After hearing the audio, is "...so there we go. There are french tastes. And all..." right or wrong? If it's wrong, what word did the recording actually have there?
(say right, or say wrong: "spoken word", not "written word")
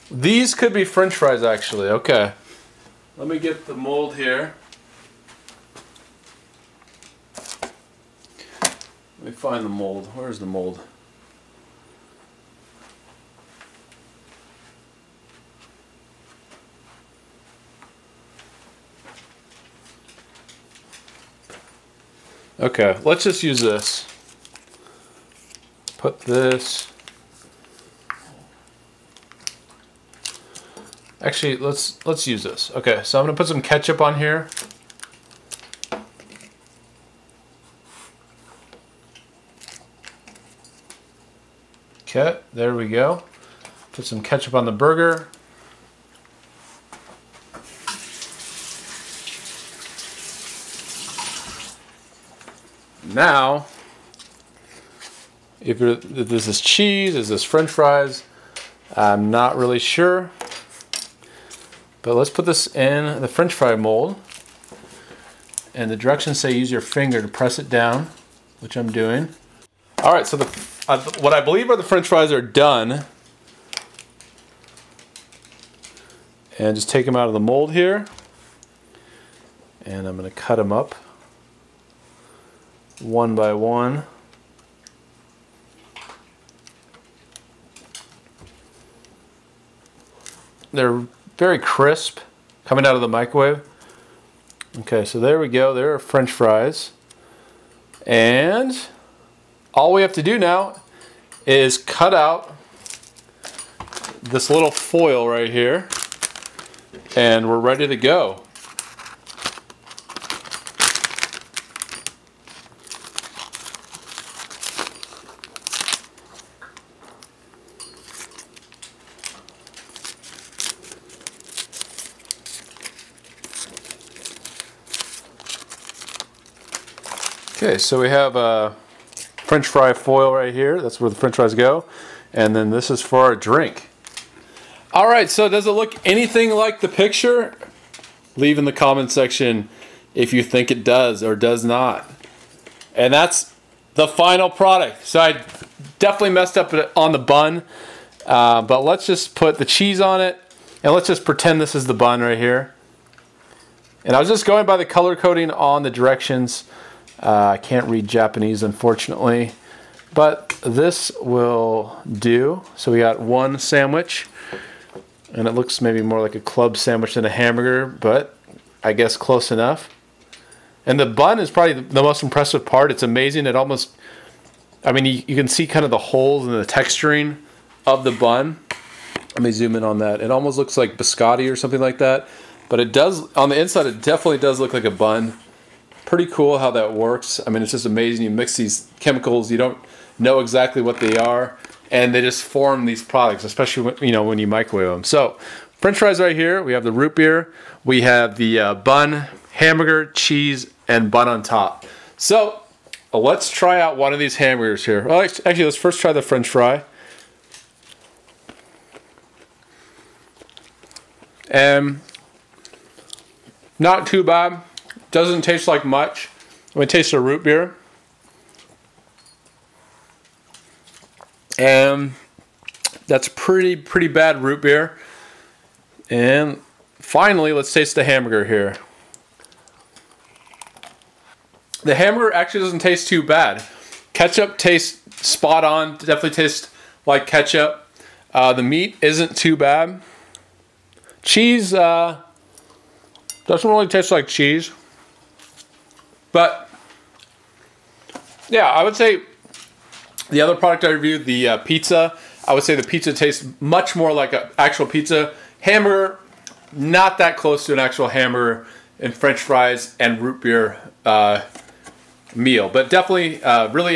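wrong: "fries", not "tastes".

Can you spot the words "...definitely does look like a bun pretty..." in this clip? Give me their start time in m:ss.
3:04.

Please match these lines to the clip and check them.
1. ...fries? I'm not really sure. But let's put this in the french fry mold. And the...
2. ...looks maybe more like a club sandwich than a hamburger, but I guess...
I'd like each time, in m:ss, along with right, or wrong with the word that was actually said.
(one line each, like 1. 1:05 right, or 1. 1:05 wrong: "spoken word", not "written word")
1. 0:57 right
2. 2:45 right.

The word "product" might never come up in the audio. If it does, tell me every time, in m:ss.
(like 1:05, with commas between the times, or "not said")
2:24, 3:13, 4:10.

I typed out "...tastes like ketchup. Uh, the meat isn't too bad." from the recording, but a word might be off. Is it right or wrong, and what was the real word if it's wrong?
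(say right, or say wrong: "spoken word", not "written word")
right.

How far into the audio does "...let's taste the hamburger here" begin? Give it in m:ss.
3:47.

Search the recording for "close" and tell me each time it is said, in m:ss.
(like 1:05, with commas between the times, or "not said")
2:49, 4:17.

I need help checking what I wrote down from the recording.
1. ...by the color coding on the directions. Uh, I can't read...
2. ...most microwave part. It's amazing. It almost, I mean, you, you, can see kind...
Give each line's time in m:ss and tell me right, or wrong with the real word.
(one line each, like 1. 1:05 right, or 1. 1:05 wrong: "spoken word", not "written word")
1. 2:34 right
2. 2:52 wrong: "impressive", not "microwave".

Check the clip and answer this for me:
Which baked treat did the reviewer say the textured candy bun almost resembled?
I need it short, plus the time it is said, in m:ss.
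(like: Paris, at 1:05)
Biscotti, at 3:00.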